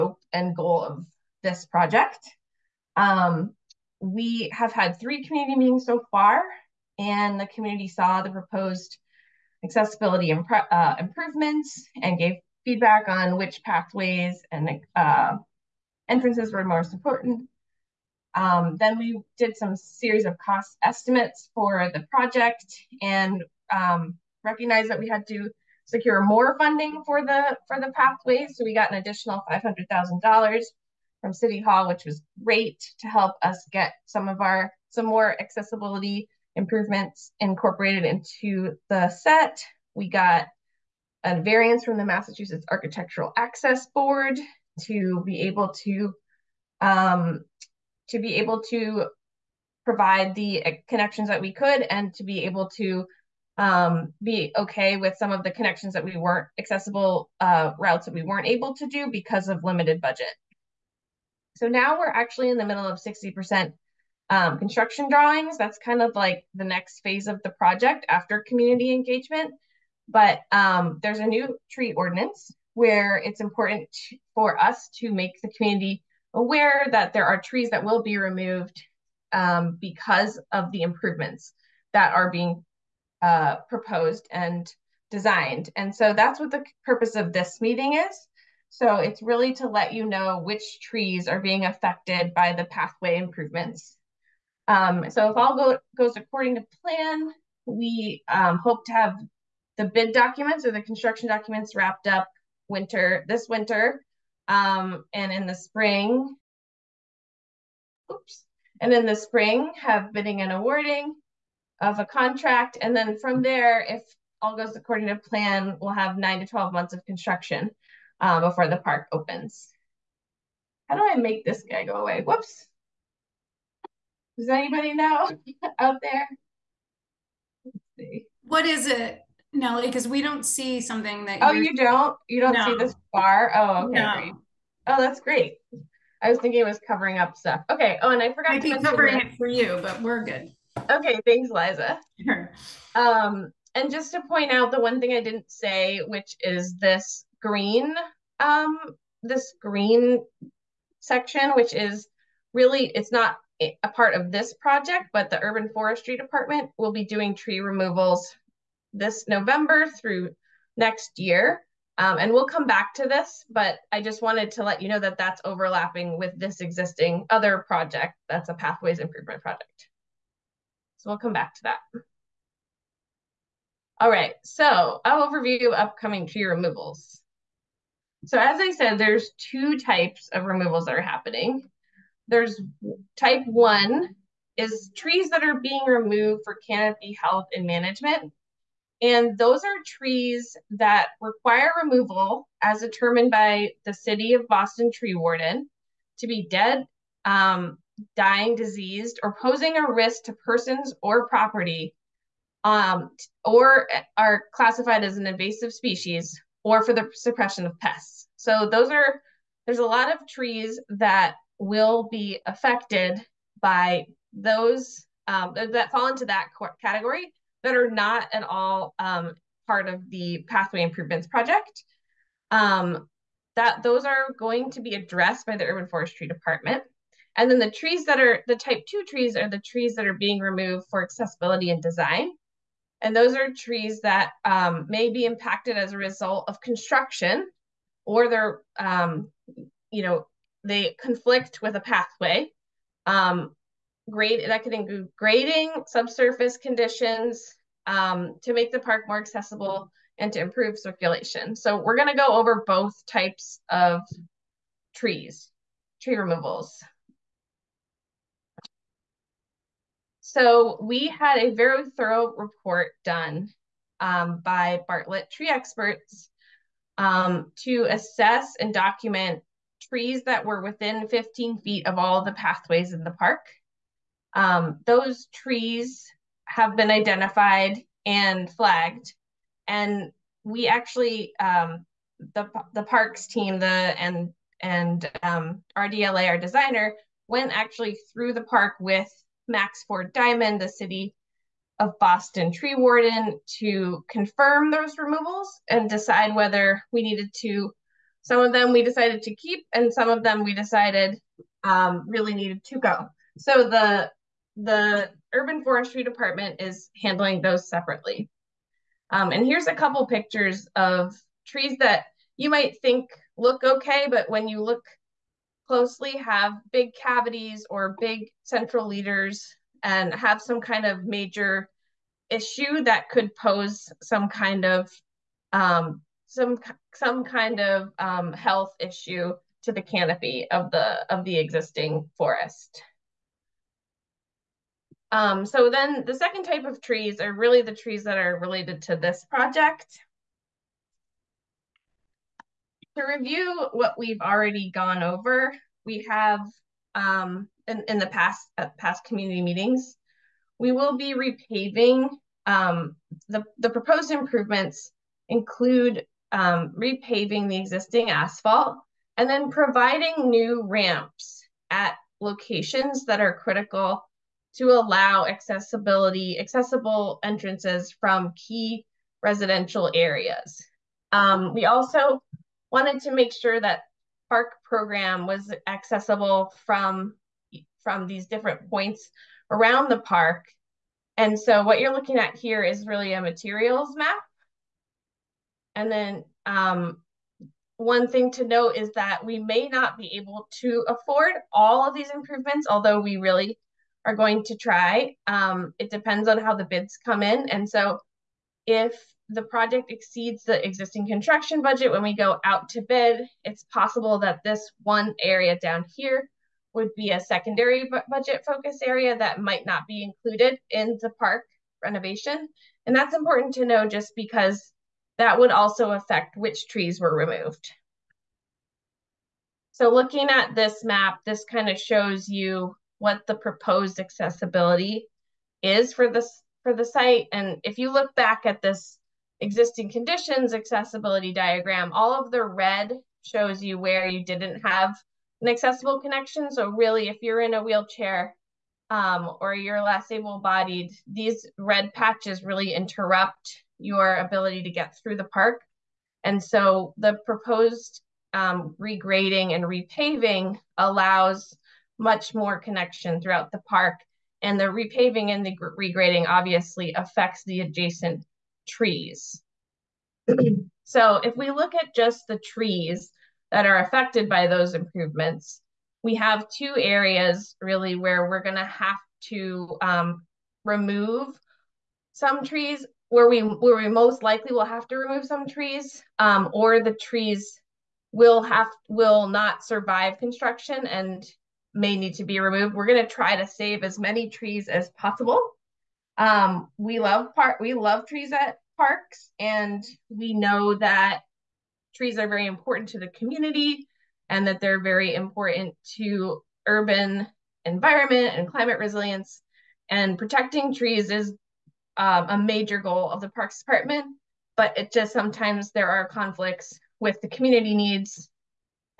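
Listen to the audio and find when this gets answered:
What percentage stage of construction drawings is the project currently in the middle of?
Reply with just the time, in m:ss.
1:02.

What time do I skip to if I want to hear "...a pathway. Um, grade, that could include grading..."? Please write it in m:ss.
4:01.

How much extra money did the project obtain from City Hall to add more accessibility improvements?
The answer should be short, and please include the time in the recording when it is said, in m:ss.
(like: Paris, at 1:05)
$500,000, at 0:29.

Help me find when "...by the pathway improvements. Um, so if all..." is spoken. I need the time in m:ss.
1:32.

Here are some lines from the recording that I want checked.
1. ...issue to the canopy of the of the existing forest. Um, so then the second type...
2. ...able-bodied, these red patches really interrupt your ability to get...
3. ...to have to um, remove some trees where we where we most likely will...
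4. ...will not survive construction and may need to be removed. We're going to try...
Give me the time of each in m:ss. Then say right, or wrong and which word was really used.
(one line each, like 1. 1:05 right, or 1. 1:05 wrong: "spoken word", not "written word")
1. 5:28 right
2. 7:20 right
3. 7:48 right
4. 7:58 right.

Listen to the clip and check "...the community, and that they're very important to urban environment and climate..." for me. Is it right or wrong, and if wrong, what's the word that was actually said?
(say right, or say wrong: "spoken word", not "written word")
right.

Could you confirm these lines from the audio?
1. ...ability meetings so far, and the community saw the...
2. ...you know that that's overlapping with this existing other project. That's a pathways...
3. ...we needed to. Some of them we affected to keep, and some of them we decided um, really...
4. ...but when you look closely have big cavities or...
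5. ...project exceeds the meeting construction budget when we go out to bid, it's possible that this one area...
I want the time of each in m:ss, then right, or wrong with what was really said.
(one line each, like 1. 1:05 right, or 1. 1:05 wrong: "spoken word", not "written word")
1. 0:05 wrong: "community", not "ability"
2. 2:44 right
3. 4:56 wrong: "decided", not "affected"
4. 5:14 right
5. 6:39 wrong: "existing", not "meeting".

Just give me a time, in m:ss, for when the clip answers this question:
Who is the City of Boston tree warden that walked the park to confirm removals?
4:49.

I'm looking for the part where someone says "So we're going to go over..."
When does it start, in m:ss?
4:11.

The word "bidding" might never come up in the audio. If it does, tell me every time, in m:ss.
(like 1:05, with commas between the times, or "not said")
1:50.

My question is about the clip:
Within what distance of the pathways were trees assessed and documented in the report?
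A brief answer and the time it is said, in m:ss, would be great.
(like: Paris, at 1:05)
15 feet, at 4:31.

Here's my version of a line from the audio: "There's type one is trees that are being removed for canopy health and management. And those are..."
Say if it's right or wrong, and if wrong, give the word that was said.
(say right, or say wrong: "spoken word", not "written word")
right.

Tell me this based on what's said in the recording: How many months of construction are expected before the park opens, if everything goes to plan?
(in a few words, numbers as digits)
9 to 12.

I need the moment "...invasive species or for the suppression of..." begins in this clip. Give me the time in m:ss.
3:25.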